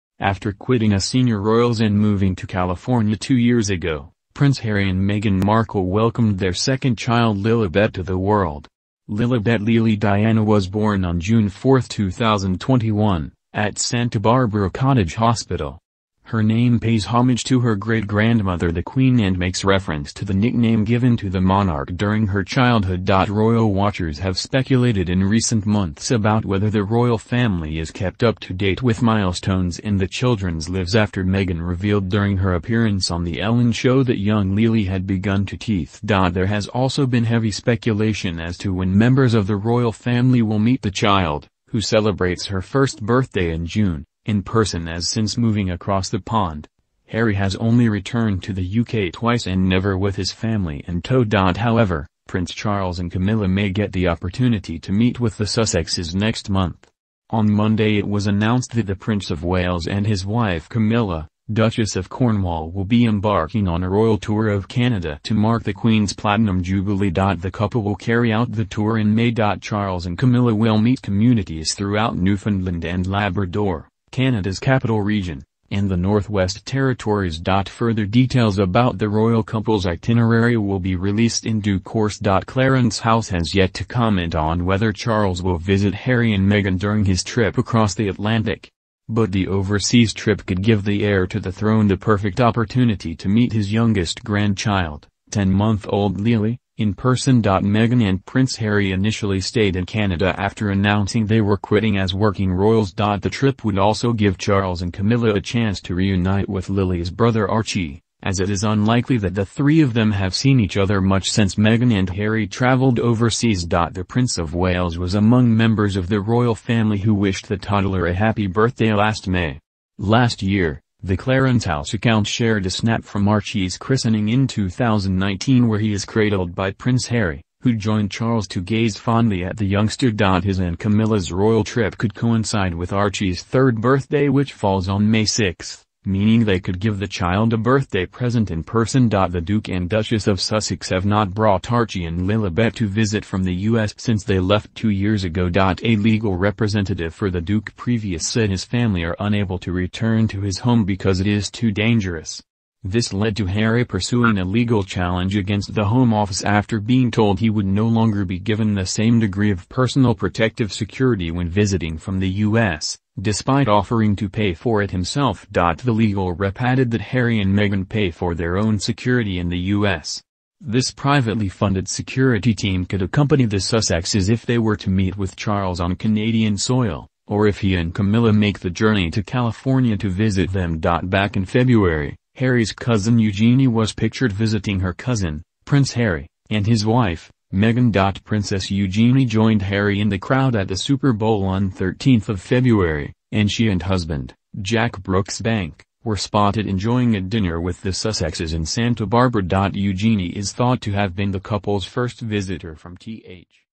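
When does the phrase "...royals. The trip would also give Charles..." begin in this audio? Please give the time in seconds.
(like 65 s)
102 s.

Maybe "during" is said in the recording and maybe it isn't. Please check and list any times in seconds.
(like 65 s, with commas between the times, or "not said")
21 s, 32 s, 86 s.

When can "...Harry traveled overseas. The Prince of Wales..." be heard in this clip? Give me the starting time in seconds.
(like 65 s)
112 s.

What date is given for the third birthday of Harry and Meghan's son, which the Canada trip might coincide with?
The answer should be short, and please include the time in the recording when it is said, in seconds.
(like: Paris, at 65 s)
May 6, at 135 s.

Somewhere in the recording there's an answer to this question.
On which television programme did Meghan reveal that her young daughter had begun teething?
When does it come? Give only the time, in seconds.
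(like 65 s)
33 s.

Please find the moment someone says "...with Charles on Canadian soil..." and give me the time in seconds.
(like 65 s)
175 s.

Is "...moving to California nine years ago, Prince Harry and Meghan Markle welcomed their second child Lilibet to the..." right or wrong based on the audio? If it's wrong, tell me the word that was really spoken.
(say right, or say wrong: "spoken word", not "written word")
wrong: "two", not "nine".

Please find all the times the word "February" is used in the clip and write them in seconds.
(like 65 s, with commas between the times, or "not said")
181 s, 192 s.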